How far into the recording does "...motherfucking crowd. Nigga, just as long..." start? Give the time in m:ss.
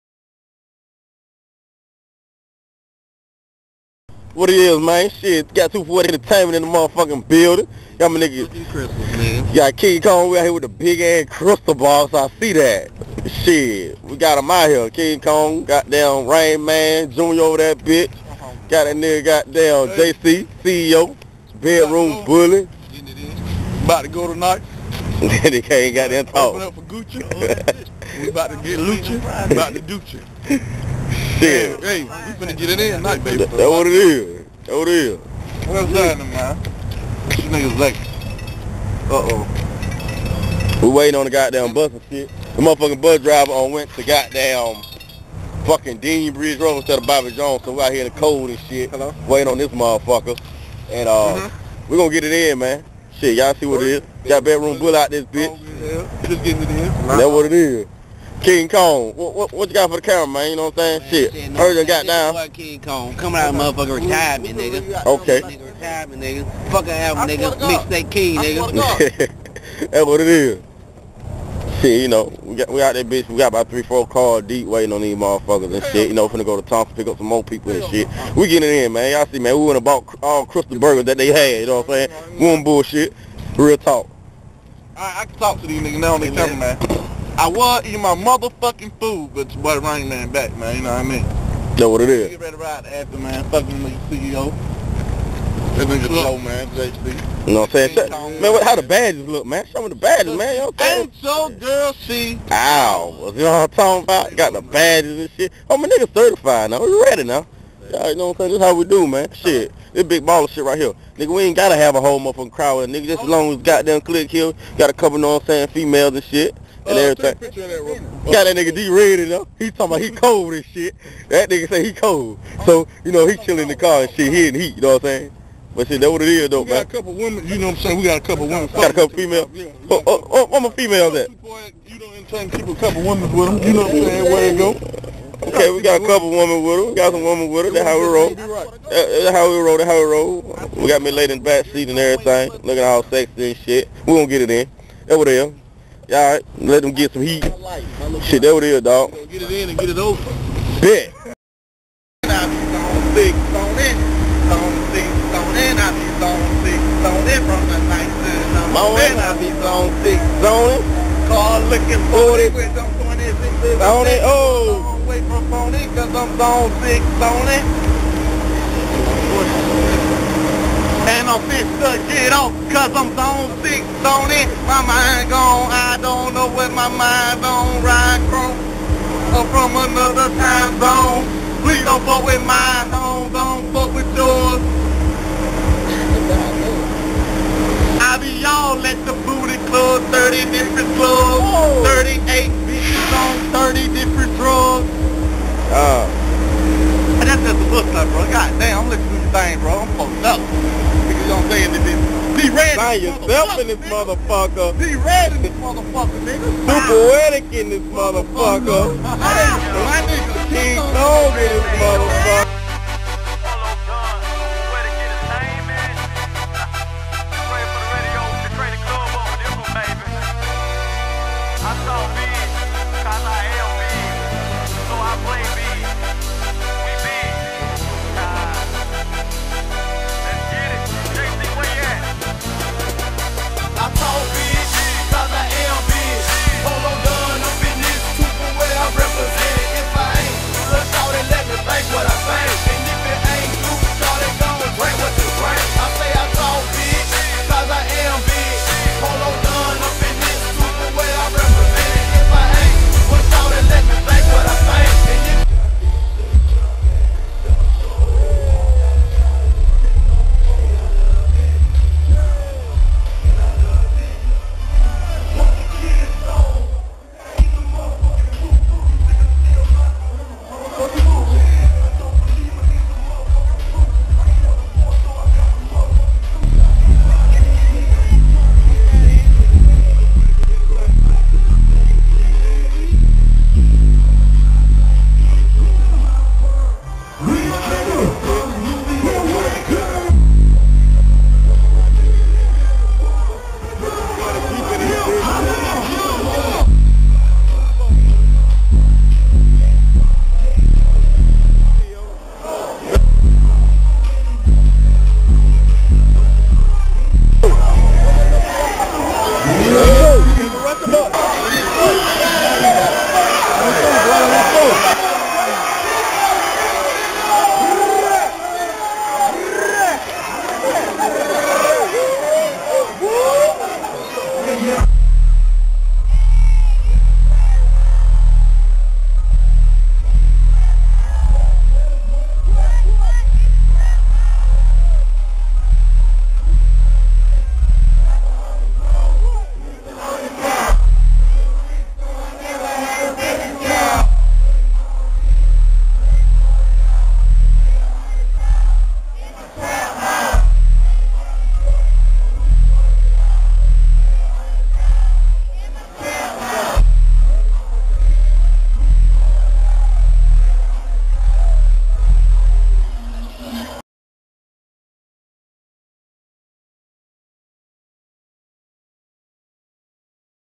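1:52.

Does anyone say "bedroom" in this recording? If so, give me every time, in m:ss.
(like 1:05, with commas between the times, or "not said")
0:21, 0:54.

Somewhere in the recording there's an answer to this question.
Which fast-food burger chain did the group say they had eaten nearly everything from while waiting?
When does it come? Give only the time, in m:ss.
1:20.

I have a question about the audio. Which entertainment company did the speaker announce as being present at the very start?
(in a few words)
240 Entertainment.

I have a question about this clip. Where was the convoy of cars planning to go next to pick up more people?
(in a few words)
Thompson.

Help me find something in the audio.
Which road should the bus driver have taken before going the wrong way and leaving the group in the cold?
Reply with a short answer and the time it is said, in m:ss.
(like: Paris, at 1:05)
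Bobby Jones, at 0:47.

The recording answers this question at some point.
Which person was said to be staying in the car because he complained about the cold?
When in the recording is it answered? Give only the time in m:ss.
1:58.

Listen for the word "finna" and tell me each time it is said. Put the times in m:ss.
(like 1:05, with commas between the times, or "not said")
0:32, 1:16.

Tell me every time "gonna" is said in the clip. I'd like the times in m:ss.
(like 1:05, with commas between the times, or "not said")
0:51, 2:24.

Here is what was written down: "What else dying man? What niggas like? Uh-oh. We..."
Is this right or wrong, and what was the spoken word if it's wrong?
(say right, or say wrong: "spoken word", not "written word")
right.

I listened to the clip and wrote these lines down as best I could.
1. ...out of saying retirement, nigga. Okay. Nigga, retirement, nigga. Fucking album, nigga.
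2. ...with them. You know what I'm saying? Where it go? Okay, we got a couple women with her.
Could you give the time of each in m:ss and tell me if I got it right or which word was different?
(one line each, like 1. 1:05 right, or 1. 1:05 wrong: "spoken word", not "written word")
1. 1:03 wrong: "motherfucking", not "saying"
2. 2:13 right.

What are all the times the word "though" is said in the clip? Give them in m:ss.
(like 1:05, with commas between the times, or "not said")
2:06.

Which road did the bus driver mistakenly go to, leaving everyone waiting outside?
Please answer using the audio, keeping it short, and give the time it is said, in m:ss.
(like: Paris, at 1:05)
Dean Bridge Road, at 0:45.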